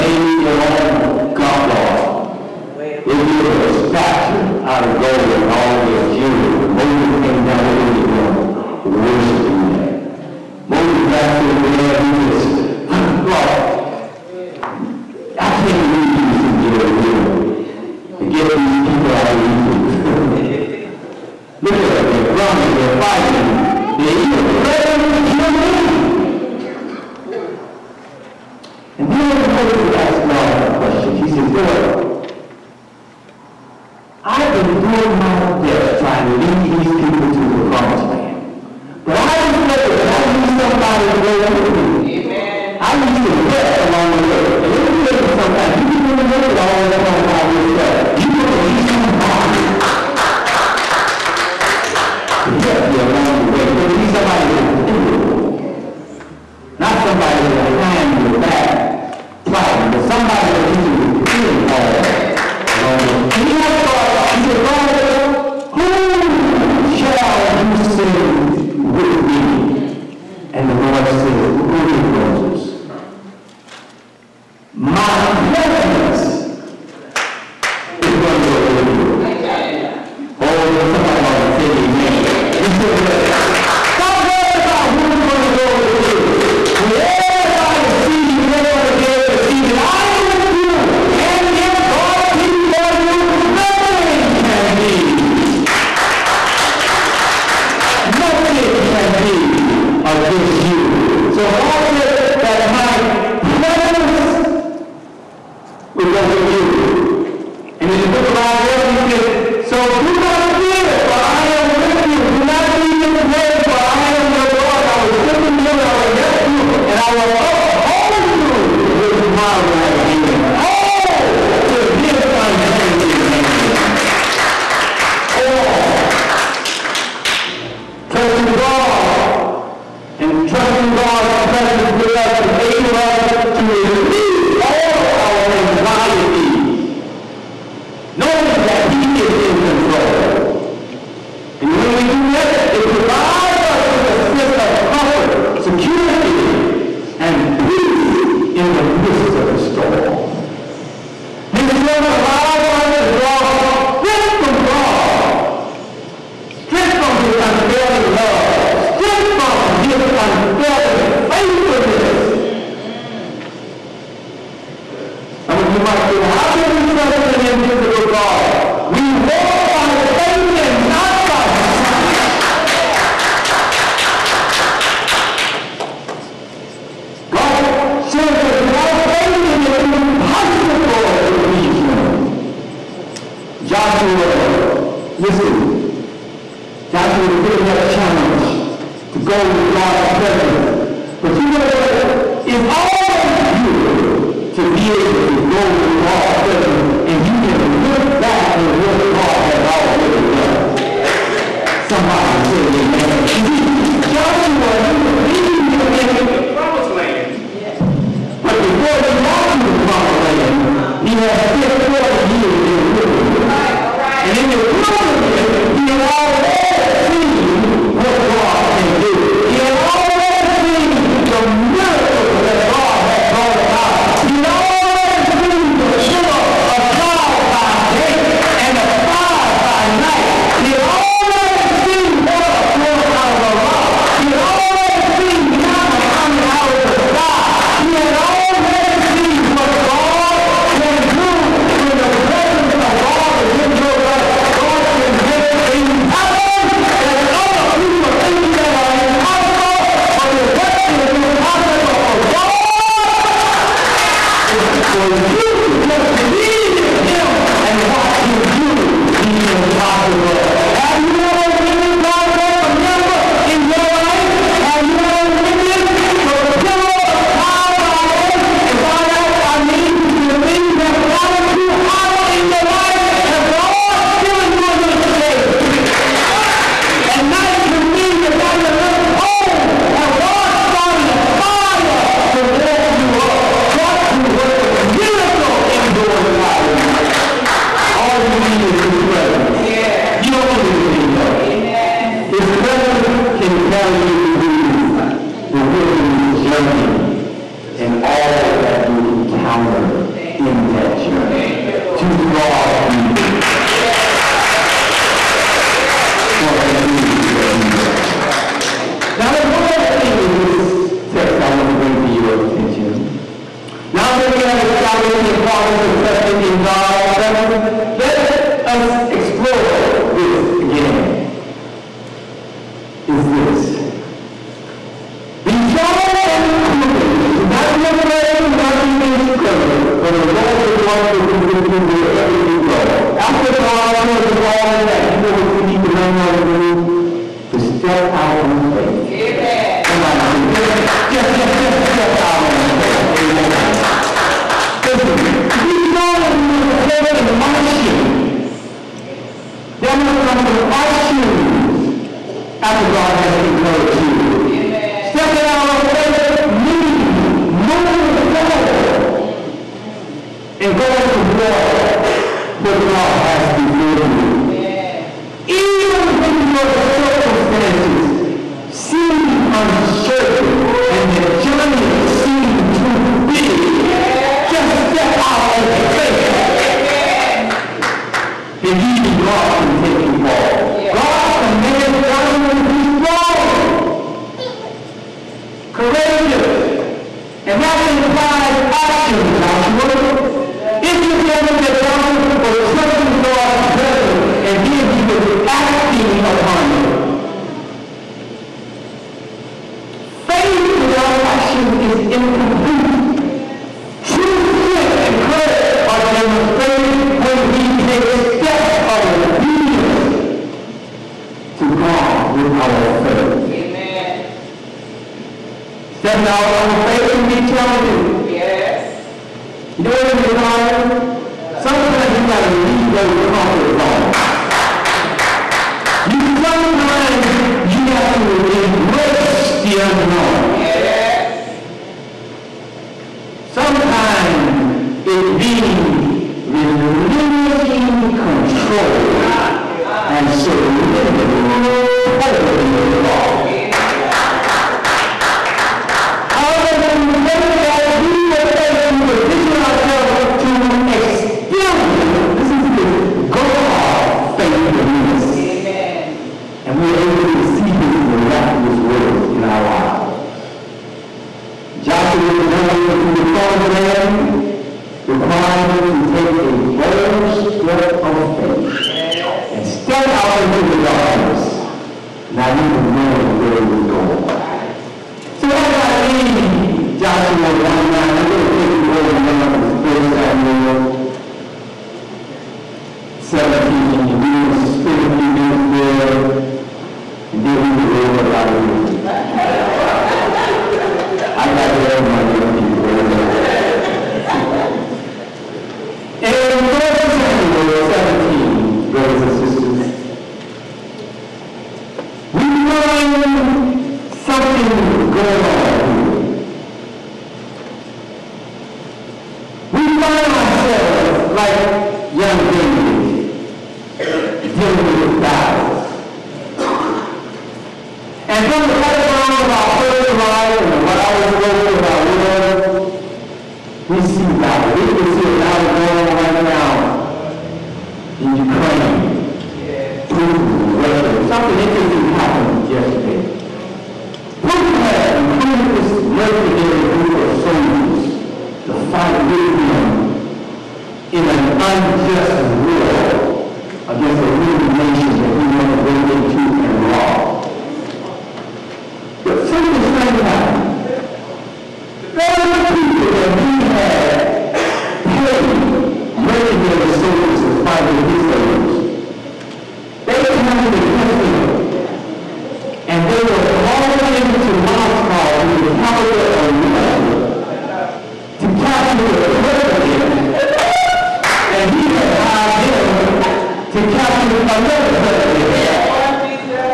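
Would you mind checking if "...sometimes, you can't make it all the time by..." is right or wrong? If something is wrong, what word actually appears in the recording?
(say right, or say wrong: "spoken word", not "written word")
right.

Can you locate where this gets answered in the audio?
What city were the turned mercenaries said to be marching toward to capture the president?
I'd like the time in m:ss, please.
9:24.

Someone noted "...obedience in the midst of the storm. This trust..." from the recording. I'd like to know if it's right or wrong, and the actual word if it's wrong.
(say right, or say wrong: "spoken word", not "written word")
wrong: "peace", not "obedience".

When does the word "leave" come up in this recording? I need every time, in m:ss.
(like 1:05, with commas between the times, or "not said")
7:02, 7:56.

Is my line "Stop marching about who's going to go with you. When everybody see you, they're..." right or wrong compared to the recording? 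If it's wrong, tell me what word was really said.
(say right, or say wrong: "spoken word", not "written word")
wrong: "worrying", not "marching".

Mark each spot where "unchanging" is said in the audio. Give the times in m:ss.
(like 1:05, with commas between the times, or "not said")
2:02.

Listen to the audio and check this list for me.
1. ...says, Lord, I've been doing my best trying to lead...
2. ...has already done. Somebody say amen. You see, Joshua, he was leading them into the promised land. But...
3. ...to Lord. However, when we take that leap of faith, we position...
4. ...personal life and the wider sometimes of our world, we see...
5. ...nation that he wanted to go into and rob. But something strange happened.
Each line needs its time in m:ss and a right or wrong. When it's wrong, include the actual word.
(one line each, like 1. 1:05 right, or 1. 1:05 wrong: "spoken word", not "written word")
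1. 0:31 right
2. 3:19 right
3. 7:22 wrong: "God", not "Lord"
4. 8:39 wrong: "scopes", not "sometimes"
5. 9:04 right.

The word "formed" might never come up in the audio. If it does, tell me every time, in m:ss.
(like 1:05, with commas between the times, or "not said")
not said.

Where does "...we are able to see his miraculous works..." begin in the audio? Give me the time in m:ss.
7:36.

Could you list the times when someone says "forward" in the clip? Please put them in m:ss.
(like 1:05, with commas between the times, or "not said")
5:58, 6:20.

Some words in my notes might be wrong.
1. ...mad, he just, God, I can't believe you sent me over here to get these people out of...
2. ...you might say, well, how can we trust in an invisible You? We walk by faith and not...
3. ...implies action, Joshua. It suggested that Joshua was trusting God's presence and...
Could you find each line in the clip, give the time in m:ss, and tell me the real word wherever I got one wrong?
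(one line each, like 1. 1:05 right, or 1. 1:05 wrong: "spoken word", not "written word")
1. 0:11 right
2. 2:45 wrong: "God", not "You"
3. 6:28 right.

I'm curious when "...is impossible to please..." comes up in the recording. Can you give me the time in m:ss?
2:59.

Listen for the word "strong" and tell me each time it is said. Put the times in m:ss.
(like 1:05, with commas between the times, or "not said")
5:25, 5:45, 6:22.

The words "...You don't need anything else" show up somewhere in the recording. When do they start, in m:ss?
4:50.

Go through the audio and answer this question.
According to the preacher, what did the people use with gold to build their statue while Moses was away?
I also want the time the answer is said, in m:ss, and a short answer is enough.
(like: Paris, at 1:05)
jewelry, at 0:05.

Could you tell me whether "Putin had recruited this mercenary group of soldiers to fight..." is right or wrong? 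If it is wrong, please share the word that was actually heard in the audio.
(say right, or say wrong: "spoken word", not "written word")
right.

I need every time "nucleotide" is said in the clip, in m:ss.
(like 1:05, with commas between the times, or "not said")
not said.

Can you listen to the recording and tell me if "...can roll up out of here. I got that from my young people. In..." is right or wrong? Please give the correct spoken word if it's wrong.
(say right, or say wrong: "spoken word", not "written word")
right.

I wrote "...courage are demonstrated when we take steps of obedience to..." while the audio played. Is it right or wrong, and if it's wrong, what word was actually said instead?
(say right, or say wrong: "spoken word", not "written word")
right.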